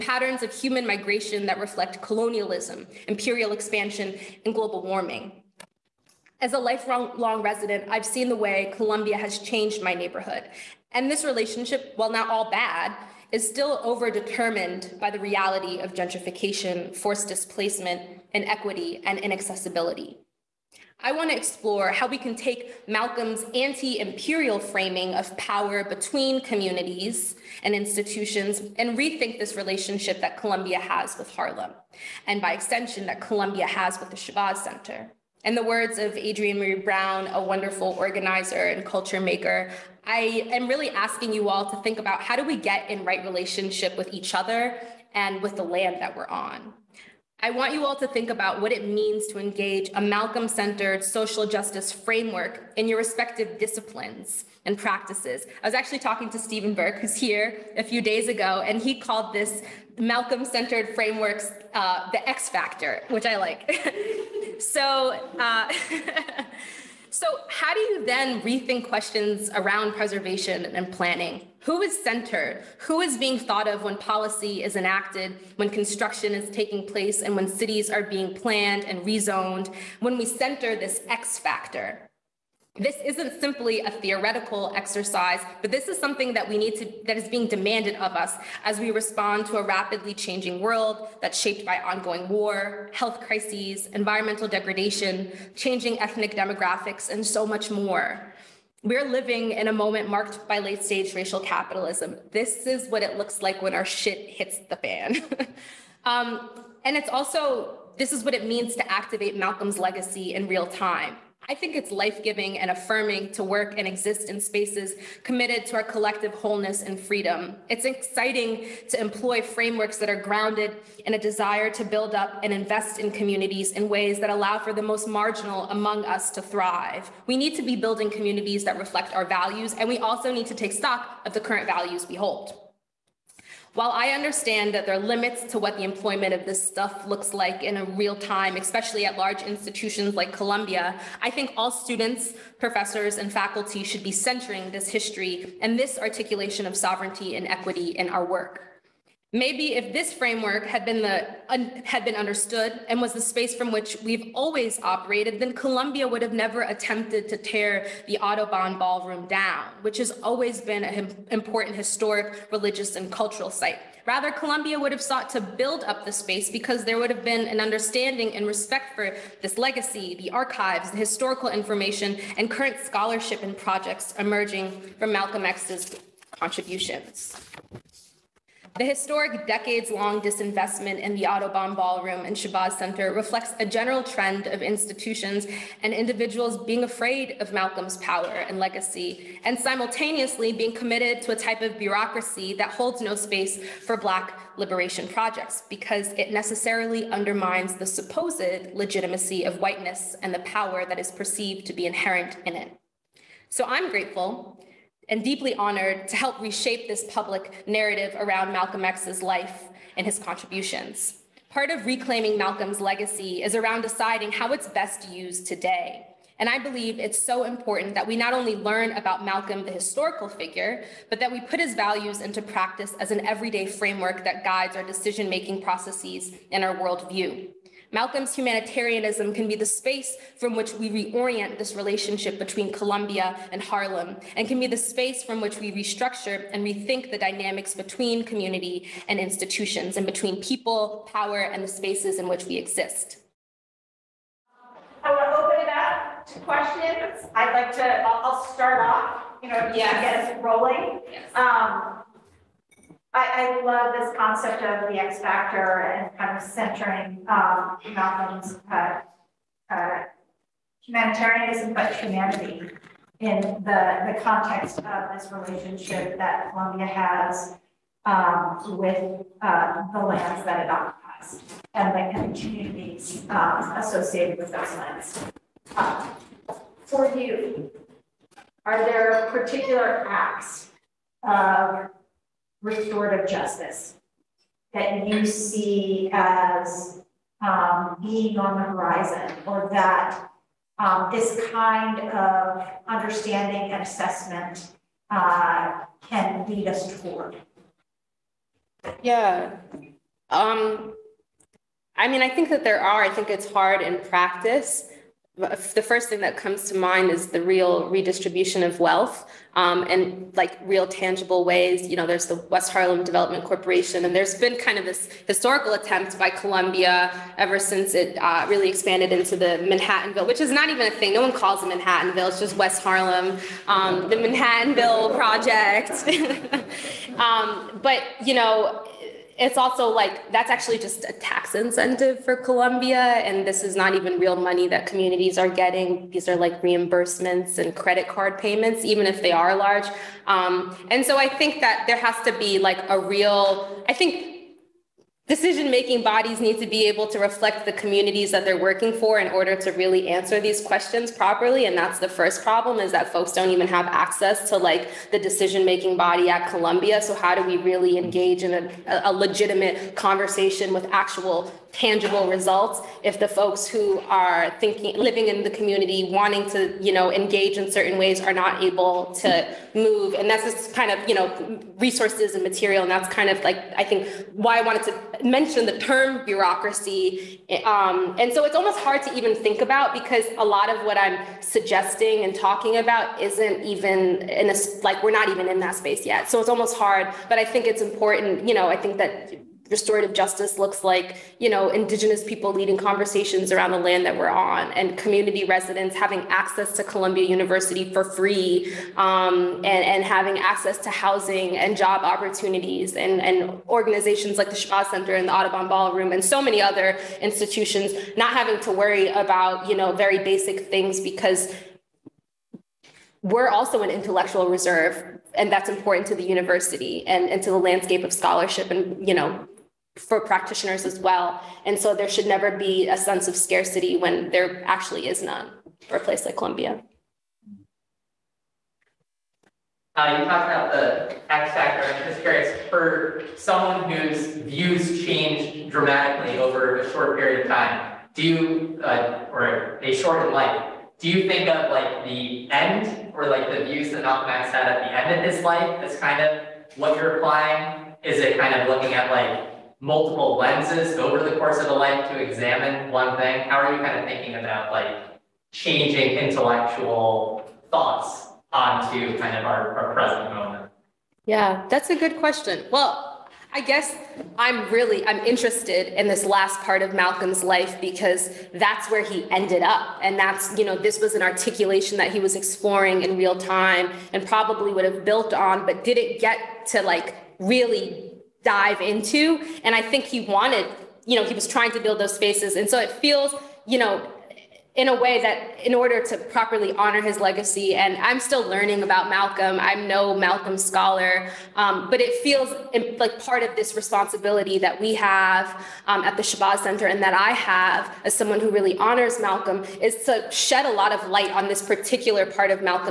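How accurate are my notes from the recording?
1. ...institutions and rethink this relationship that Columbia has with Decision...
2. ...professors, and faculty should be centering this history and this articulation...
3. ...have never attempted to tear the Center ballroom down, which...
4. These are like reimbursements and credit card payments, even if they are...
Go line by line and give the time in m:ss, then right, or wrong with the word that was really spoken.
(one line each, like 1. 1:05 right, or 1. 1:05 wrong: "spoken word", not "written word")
1. 0:27 wrong: "Harlem", not "Decision"
2. 2:22 right
3. 2:36 wrong: "Audubon", not "Center"
4. 5:36 right.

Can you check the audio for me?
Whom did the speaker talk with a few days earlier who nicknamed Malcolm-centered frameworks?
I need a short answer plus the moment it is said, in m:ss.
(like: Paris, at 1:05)
Stephen Burke, at 0:56.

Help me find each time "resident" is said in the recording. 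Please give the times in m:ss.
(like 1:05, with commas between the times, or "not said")
0:07, 6:35.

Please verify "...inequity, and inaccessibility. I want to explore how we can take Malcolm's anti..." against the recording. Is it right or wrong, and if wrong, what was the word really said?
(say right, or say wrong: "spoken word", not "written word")
right.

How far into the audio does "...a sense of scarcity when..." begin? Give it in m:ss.
7:02.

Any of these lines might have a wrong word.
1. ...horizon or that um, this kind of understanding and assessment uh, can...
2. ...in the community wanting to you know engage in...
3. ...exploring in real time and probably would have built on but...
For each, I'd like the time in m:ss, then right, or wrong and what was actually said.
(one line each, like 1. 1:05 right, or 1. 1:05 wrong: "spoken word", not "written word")
1. 4:48 right
2. 6:05 right
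3. 7:52 right.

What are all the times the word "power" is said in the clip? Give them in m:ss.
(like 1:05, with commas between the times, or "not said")
0:25, 3:07, 3:20, 4:01.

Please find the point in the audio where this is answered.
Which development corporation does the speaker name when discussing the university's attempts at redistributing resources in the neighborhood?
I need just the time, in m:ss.
5:12.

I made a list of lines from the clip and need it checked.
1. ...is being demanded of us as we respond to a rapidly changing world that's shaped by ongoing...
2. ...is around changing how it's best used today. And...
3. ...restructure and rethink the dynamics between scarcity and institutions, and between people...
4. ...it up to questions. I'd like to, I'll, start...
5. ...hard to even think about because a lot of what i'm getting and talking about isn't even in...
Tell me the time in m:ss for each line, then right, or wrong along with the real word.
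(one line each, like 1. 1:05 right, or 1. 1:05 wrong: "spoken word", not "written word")
1. 1:27 right
2. 3:33 wrong: "deciding", not "changing"
3. 3:55 wrong: "community", not "scarcity"
4. 4:05 right
5. 6:18 wrong: "suggesting", not "getting".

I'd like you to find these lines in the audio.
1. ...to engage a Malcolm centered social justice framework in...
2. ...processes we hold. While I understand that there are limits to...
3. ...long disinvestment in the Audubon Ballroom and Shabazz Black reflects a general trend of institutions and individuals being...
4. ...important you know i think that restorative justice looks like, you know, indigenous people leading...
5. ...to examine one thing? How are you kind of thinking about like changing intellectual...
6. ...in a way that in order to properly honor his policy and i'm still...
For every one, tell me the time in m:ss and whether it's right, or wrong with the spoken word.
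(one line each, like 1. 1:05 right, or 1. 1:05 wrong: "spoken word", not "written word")
1. 0:49 right
2. 2:11 wrong: "values", not "processes"
3. 2:59 wrong: "Center", not "Black"
4. 6:27 right
5. 7:32 right
6. 8:04 wrong: "legacy", not "policy".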